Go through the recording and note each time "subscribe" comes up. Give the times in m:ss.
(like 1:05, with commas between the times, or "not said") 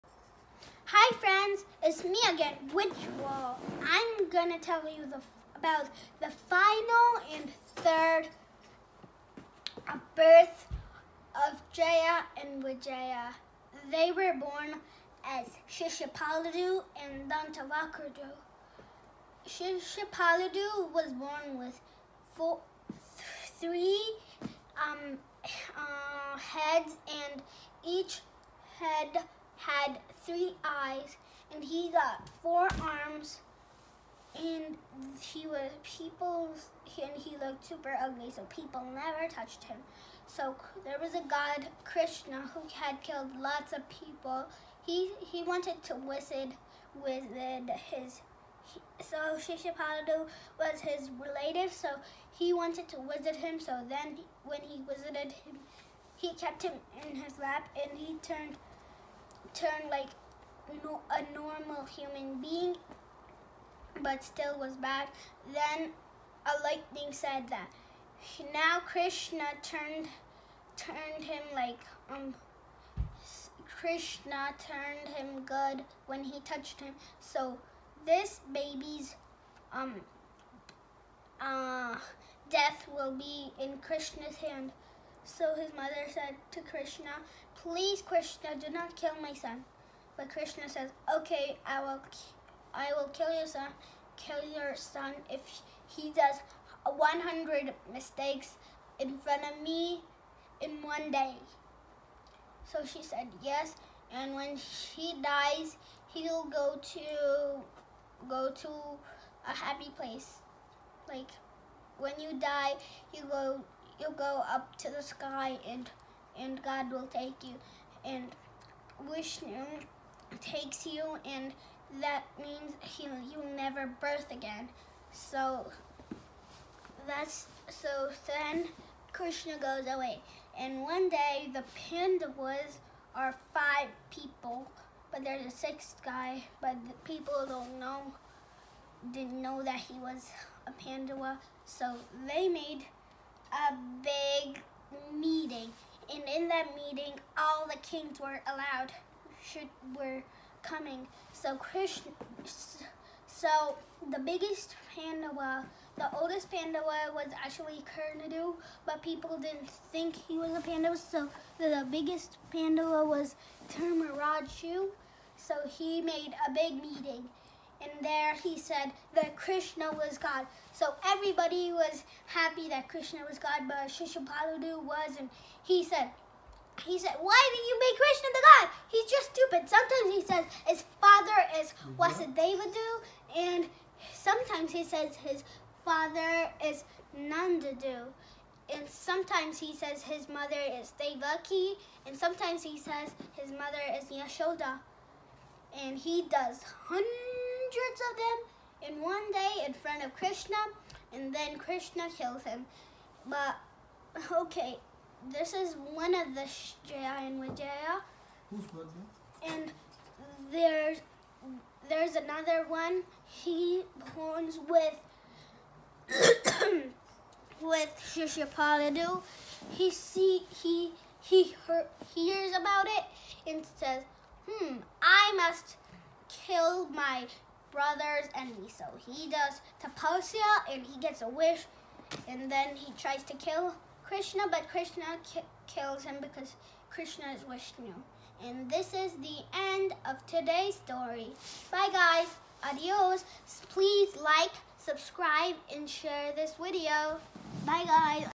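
4:04.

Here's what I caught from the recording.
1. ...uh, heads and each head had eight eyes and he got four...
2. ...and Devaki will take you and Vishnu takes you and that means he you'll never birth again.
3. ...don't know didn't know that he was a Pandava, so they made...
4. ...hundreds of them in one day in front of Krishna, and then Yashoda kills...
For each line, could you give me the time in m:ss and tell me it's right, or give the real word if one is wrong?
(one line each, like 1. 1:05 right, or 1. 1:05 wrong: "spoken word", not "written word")
1. 0:25 wrong: "three", not "eight"
2. 1:56 wrong: "God", not "Devaki"
3. 2:17 right
4. 3:17 wrong: "Krishna", not "Yashoda".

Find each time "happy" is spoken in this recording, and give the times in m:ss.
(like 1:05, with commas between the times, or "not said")
1:49, 2:52.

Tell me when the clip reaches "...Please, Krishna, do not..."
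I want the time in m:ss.
1:27.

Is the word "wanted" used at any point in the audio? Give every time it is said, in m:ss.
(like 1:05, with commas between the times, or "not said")
0:45, 0:52.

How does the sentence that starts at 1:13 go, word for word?
Krishna turned him good when he touched him.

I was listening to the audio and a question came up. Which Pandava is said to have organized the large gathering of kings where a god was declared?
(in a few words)
Dharmaraju.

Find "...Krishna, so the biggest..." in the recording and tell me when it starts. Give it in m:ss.
2:31.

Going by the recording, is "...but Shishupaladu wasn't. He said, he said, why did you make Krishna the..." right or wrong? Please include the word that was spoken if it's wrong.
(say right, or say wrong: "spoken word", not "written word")
right.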